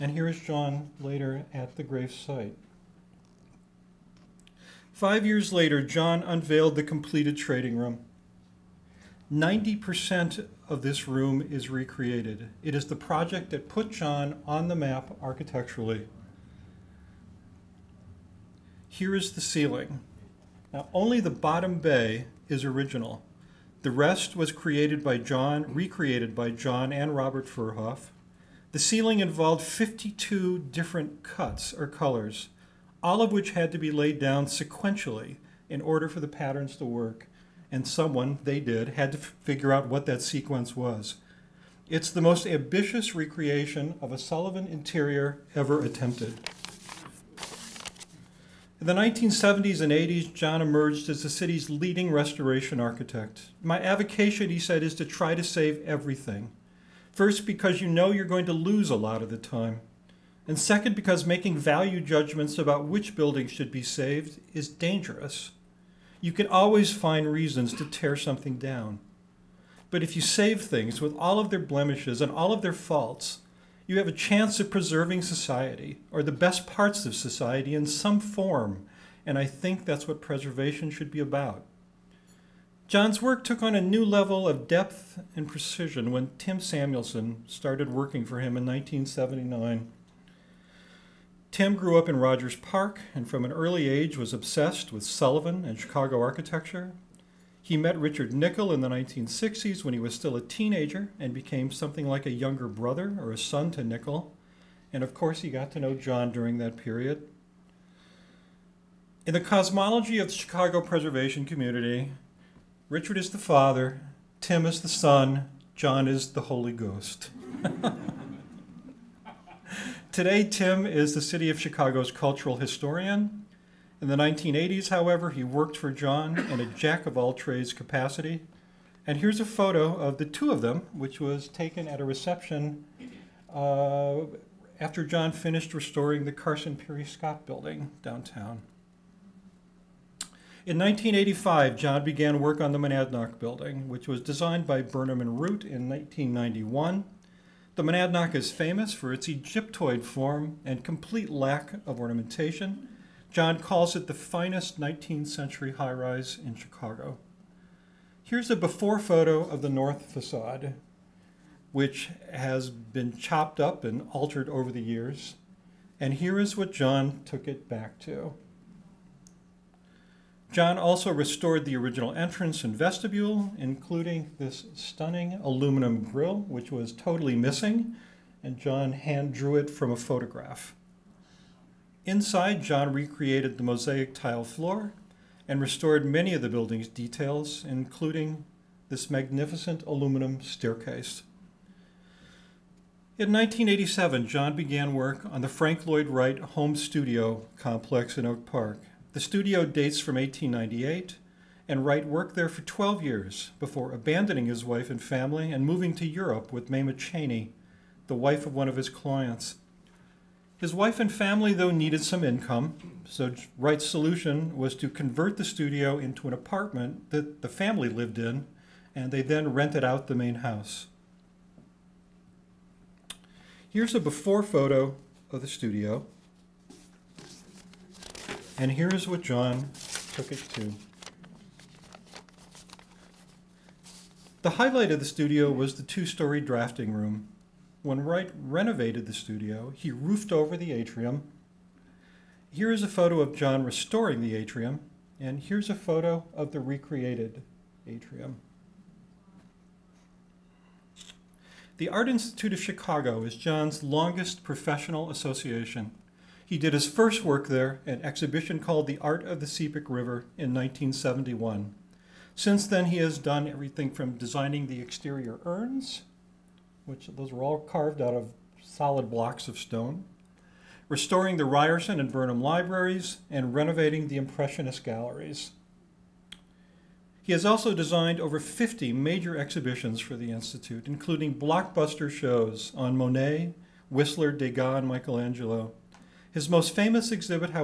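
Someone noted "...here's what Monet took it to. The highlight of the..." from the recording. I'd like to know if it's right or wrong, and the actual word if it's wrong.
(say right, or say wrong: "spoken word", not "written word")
wrong: "John", not "Monet".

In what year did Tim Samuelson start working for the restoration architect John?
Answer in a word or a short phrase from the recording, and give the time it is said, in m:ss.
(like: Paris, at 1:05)
1979, at 1:28.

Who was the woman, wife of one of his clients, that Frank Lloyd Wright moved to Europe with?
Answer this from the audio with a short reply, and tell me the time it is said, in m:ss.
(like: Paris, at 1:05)
Mamah Cheney, at 3:26.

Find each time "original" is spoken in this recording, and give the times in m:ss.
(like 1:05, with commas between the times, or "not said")
0:22, 2:51.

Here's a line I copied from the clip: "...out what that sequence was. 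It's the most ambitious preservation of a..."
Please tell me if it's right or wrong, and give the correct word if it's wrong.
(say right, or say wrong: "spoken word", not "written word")
wrong: "recreation", not "preservation".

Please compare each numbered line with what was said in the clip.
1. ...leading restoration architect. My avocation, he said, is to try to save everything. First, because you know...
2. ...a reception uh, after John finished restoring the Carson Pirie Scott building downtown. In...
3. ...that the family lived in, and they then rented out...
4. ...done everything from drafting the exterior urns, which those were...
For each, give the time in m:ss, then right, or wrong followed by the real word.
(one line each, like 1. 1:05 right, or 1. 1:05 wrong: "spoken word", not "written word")
1. 0:51 right
2. 2:12 right
3. 3:37 right
4. 4:23 wrong: "designing", not "drafting".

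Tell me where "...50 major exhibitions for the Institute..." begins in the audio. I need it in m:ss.
4:38.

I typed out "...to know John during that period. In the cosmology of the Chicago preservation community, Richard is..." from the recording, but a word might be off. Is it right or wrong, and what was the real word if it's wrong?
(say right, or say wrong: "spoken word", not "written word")
right.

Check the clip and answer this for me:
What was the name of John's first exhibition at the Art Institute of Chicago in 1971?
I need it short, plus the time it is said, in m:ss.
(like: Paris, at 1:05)
The Art of the Sepik River, at 4:18.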